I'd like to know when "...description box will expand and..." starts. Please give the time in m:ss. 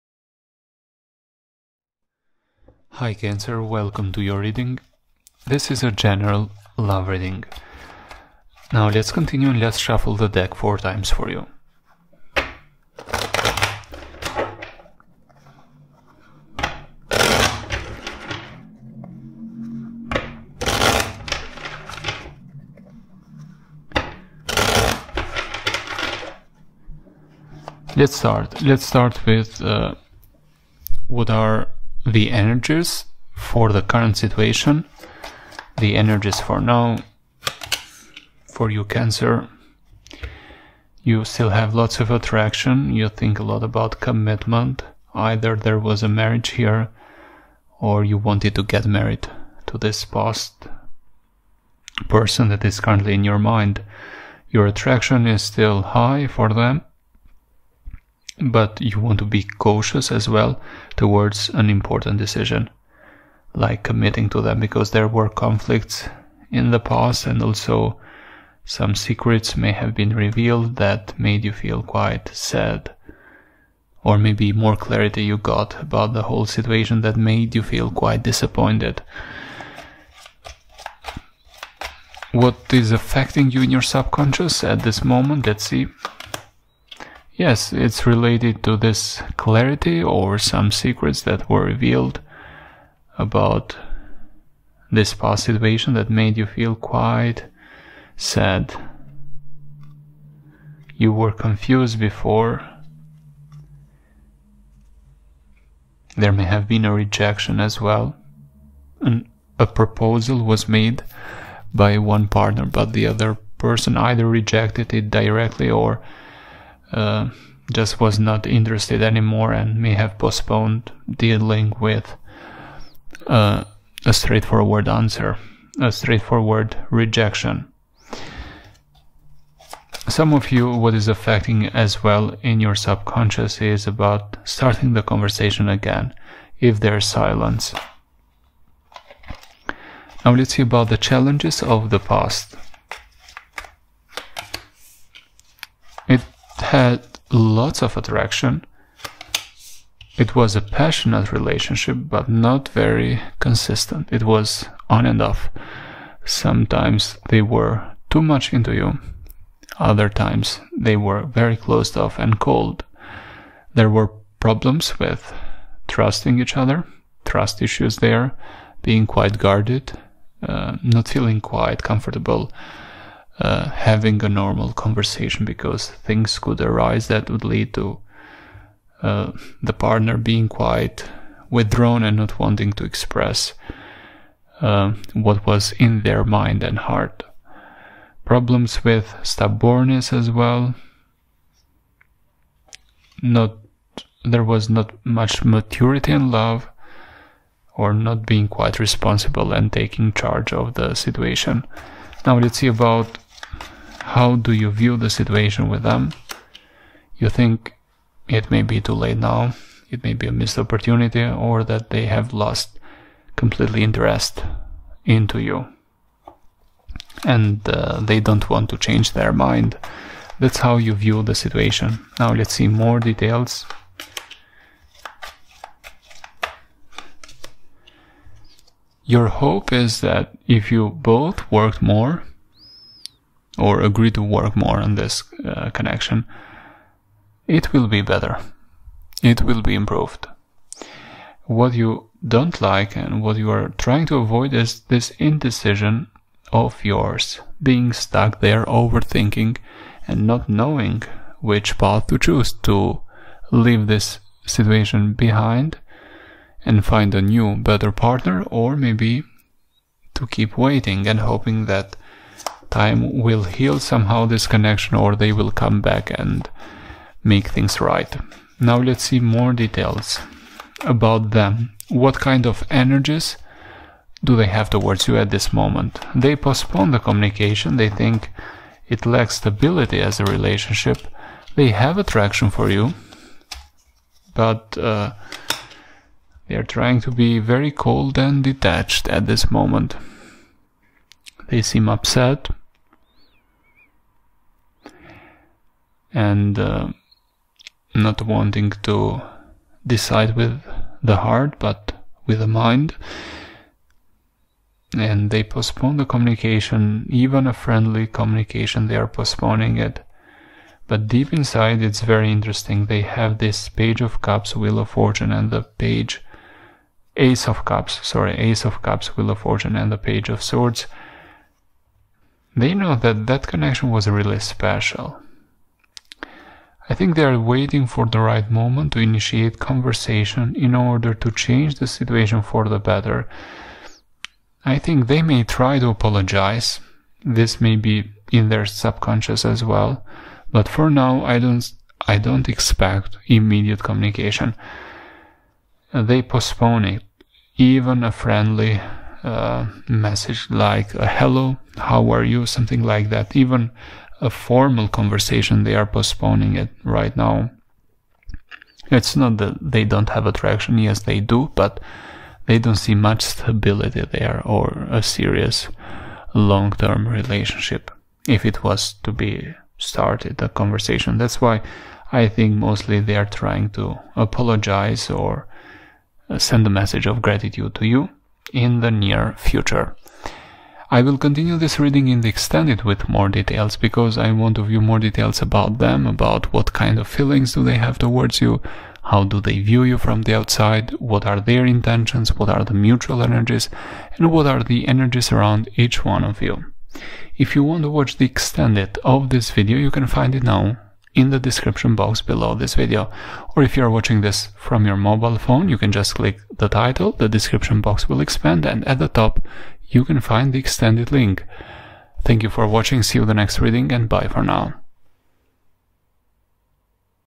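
6:47.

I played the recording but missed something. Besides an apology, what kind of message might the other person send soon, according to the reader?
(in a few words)
gratitude.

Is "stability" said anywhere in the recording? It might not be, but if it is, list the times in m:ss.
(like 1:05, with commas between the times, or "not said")
4:39, 6:03.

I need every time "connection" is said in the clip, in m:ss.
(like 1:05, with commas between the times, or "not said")
3:55, 4:24, 5:23.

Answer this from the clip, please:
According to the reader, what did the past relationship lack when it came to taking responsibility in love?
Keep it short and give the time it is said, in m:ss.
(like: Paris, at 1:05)
maturity, at 3:15.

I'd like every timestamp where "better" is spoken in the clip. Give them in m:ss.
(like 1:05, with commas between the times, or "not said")
3:58, 4:17, 5:32.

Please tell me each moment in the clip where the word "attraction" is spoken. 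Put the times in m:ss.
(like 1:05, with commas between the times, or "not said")
0:42, 0:54, 2:27, 4:41, 6:00.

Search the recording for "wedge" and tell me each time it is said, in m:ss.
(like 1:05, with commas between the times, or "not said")
not said.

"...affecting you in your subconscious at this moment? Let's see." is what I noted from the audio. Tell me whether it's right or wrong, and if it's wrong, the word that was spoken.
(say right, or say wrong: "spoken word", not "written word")
right.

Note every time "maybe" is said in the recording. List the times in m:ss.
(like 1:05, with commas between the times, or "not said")
1:14, 4:18.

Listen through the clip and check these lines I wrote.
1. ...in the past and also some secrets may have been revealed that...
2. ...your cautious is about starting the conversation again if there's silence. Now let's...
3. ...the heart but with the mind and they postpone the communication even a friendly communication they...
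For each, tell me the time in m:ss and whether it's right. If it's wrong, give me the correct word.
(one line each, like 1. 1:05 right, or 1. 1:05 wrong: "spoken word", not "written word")
1. 1:06 right
2. 2:12 wrong: "subconscious", not "cautious"
3. 5:01 right.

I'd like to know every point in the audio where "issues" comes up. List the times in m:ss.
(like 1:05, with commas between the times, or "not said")
2:47.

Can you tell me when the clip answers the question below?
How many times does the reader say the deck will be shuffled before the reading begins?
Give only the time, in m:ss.
0:10.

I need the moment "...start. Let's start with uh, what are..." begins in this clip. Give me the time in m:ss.
0:28.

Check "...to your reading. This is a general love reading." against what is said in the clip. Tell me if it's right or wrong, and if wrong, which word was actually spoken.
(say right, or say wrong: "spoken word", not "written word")
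right.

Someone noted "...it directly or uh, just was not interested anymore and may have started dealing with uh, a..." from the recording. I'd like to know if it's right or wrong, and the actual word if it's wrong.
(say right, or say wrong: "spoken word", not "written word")
wrong: "postponed", not "started".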